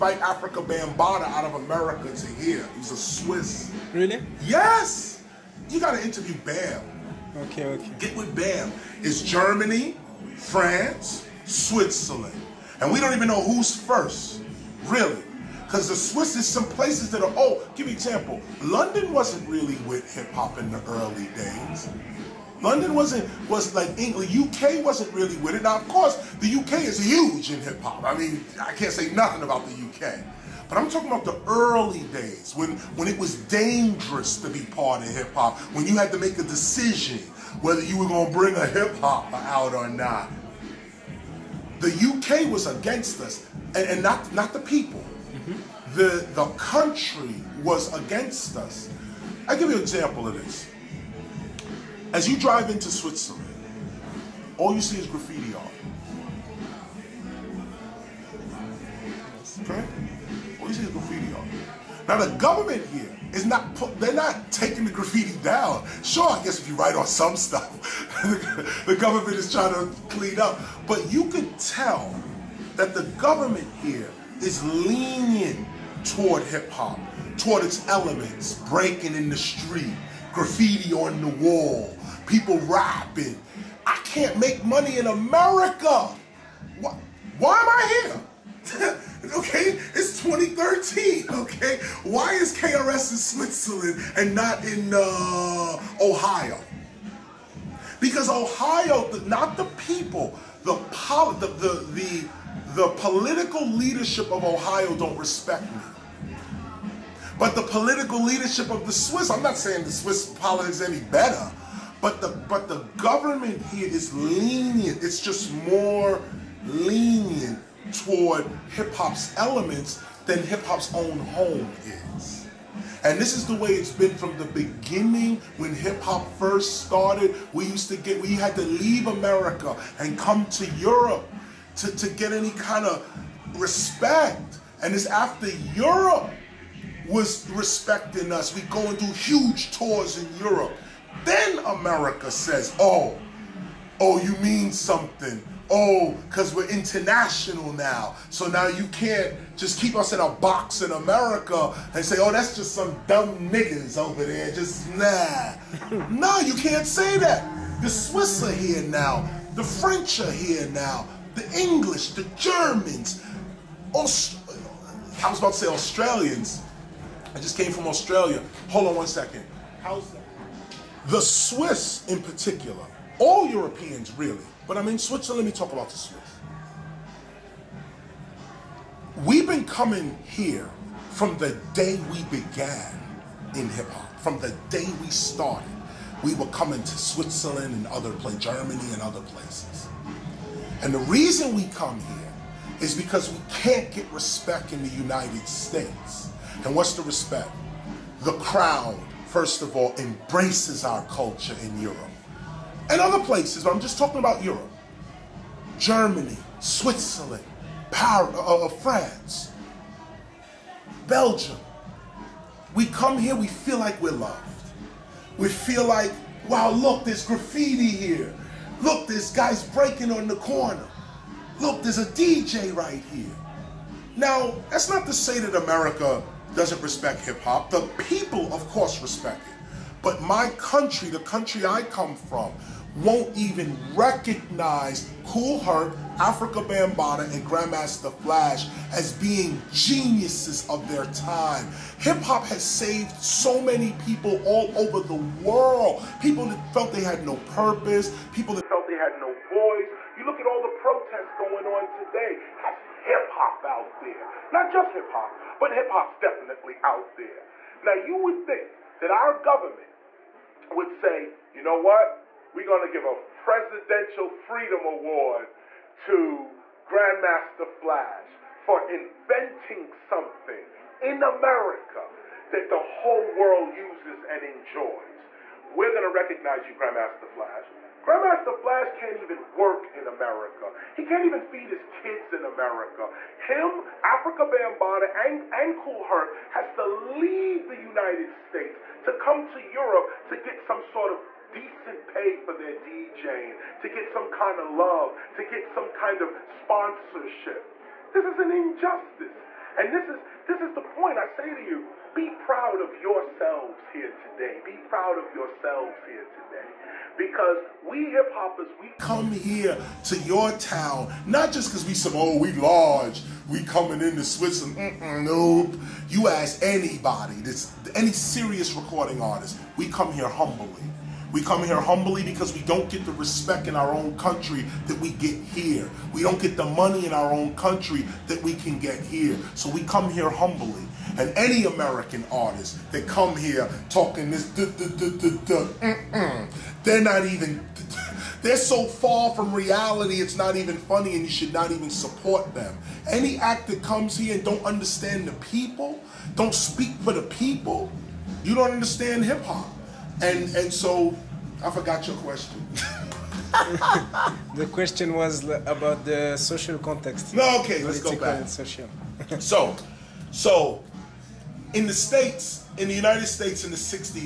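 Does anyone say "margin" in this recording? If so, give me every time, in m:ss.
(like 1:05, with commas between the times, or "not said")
not said.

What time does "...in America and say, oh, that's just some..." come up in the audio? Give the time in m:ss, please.
2:30.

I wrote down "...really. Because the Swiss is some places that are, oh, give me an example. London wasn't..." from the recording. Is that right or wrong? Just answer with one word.
right.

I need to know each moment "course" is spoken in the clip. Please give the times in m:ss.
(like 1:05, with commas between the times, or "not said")
0:25, 3:48.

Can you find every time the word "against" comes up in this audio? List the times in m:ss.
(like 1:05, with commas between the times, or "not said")
0:42, 0:47.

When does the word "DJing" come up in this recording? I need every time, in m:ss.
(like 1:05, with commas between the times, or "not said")
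4:52.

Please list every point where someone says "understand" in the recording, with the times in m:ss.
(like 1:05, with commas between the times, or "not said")
5:44, 5:48.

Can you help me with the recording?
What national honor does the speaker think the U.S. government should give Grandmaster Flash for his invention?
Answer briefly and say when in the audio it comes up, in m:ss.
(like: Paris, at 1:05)
Presidential Freedom Award, at 4:23.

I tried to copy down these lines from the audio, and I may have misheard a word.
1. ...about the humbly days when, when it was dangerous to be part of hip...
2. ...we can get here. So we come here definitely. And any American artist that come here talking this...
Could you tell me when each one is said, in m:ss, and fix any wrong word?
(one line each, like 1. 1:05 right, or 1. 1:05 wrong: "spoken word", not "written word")
1. 0:31 wrong: "early", not "humbly"
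2. 5:28 wrong: "humbly", not "definitely".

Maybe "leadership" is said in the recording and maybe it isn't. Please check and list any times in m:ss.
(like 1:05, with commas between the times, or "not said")
1:43, 1:48.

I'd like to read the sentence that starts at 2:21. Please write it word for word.
Then America says, oh, oh, you mean something.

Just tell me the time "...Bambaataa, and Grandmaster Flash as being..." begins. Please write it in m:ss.
3:56.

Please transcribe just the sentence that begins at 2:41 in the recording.
The English, the Germans, Aust- I was about to say Australians.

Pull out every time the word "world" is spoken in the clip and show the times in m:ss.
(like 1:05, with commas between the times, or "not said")
4:05, 4:33.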